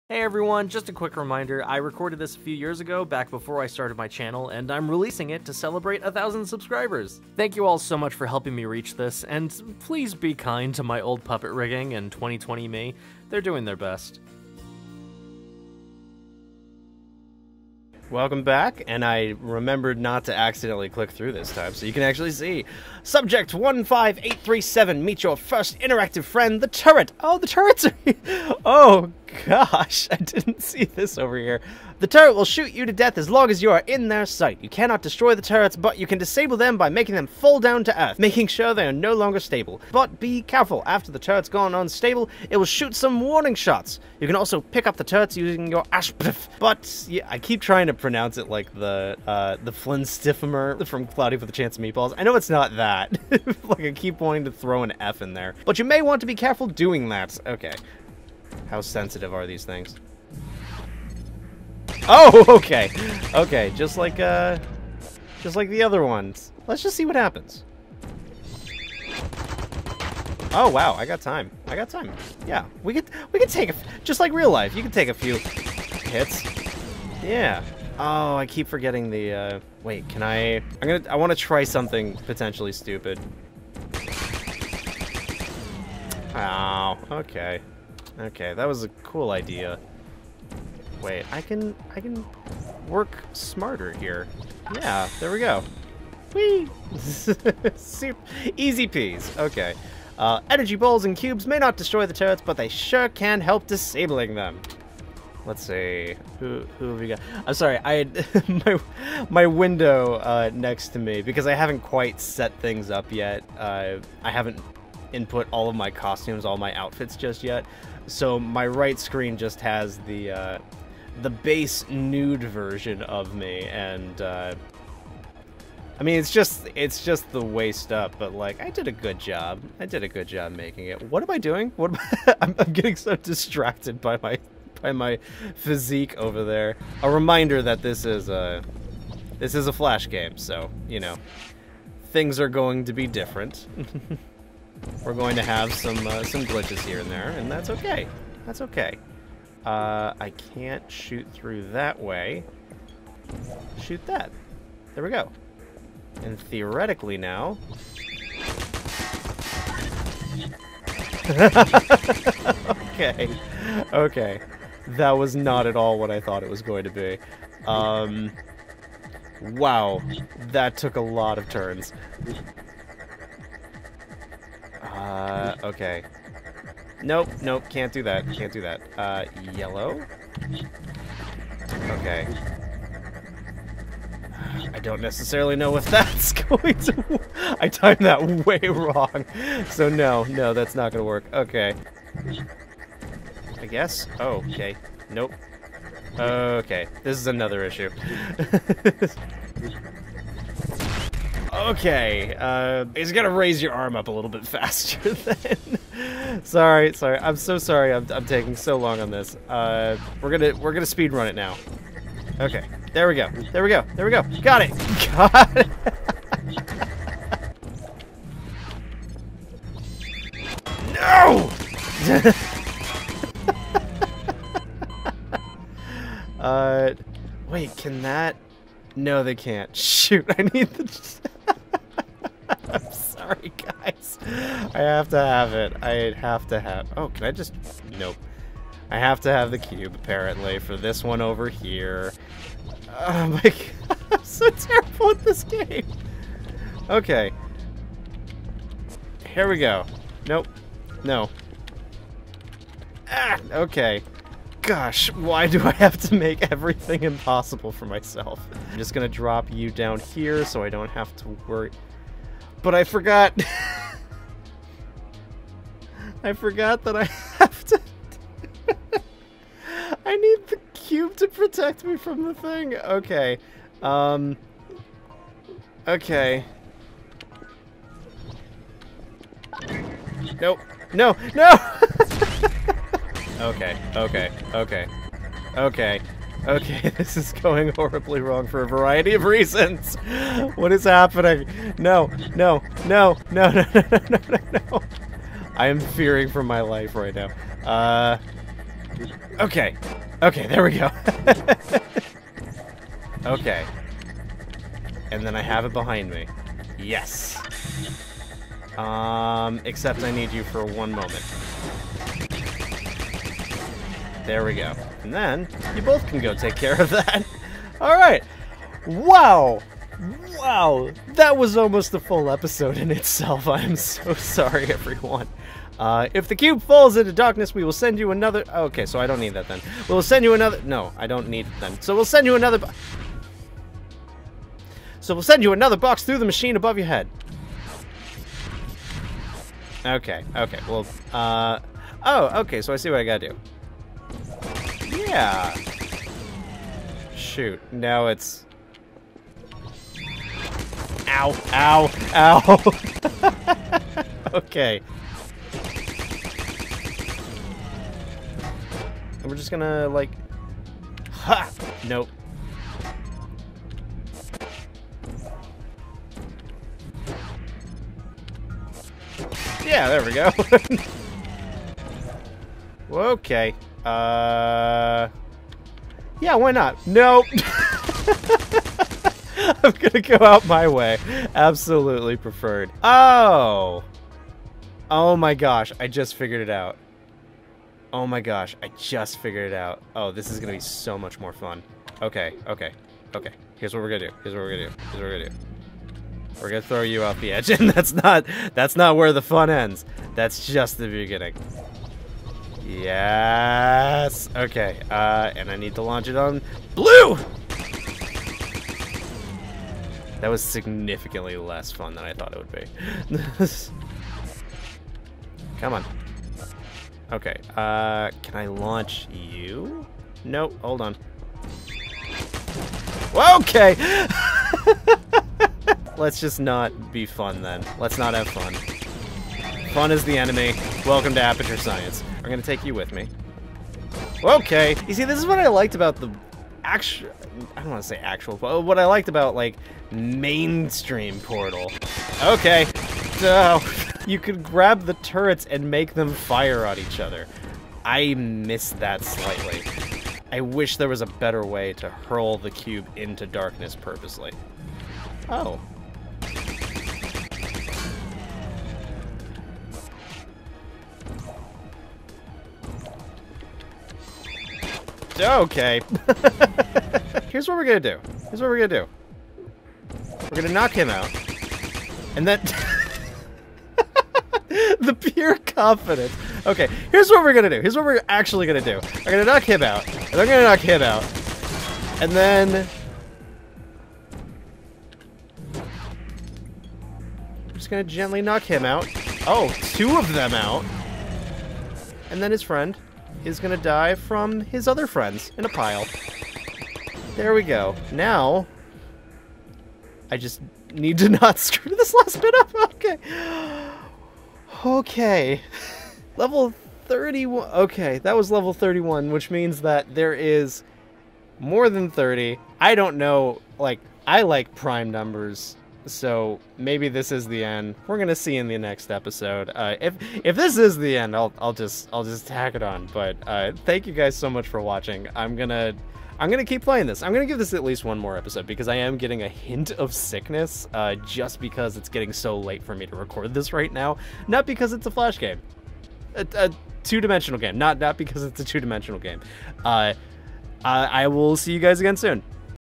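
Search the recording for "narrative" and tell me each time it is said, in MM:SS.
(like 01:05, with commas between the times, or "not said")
not said.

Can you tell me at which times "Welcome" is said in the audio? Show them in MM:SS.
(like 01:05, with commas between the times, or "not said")
00:18, 07:10.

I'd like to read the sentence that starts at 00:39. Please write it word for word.
But be careful, after the turret's gone unstable, it will shoot some warning shots.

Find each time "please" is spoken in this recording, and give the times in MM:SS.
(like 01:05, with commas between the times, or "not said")
00:09.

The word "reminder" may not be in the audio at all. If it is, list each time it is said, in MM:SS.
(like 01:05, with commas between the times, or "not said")
00:01, 02:17.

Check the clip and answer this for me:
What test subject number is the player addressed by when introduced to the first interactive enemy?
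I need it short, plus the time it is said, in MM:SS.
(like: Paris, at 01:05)
15837, at 00:23.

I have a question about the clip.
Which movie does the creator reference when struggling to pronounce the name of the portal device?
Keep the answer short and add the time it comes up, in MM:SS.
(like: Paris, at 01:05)
Cloudy with a Chance of Meatballs, at 00:51.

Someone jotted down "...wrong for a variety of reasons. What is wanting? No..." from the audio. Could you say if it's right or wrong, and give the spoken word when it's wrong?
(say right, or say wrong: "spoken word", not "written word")
wrong: "happening", not "wanting".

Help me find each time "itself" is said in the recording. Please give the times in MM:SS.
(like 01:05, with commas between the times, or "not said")
05:22.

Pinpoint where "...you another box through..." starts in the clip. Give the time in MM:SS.
05:35.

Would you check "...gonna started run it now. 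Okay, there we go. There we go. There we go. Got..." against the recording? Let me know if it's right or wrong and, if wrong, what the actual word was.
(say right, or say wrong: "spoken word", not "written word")
wrong: "speed", not "started".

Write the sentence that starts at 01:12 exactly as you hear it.
Yeah, we could, we could take, a, just like real life, you can take a few hits.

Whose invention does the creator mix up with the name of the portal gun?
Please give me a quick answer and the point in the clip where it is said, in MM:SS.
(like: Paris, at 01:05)
Flynn Stiffimer, at 00:49.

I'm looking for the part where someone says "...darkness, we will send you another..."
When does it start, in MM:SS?
05:27.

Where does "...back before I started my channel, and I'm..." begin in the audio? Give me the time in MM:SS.
00:03.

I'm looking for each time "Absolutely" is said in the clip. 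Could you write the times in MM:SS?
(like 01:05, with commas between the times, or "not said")
06:21.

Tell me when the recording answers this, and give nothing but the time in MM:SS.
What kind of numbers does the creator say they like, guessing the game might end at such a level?
08:34.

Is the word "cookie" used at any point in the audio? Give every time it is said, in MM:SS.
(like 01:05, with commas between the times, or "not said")
not said.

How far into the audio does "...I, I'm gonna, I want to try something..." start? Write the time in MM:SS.
01:20.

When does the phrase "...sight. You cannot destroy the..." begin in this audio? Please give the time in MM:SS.
00:34.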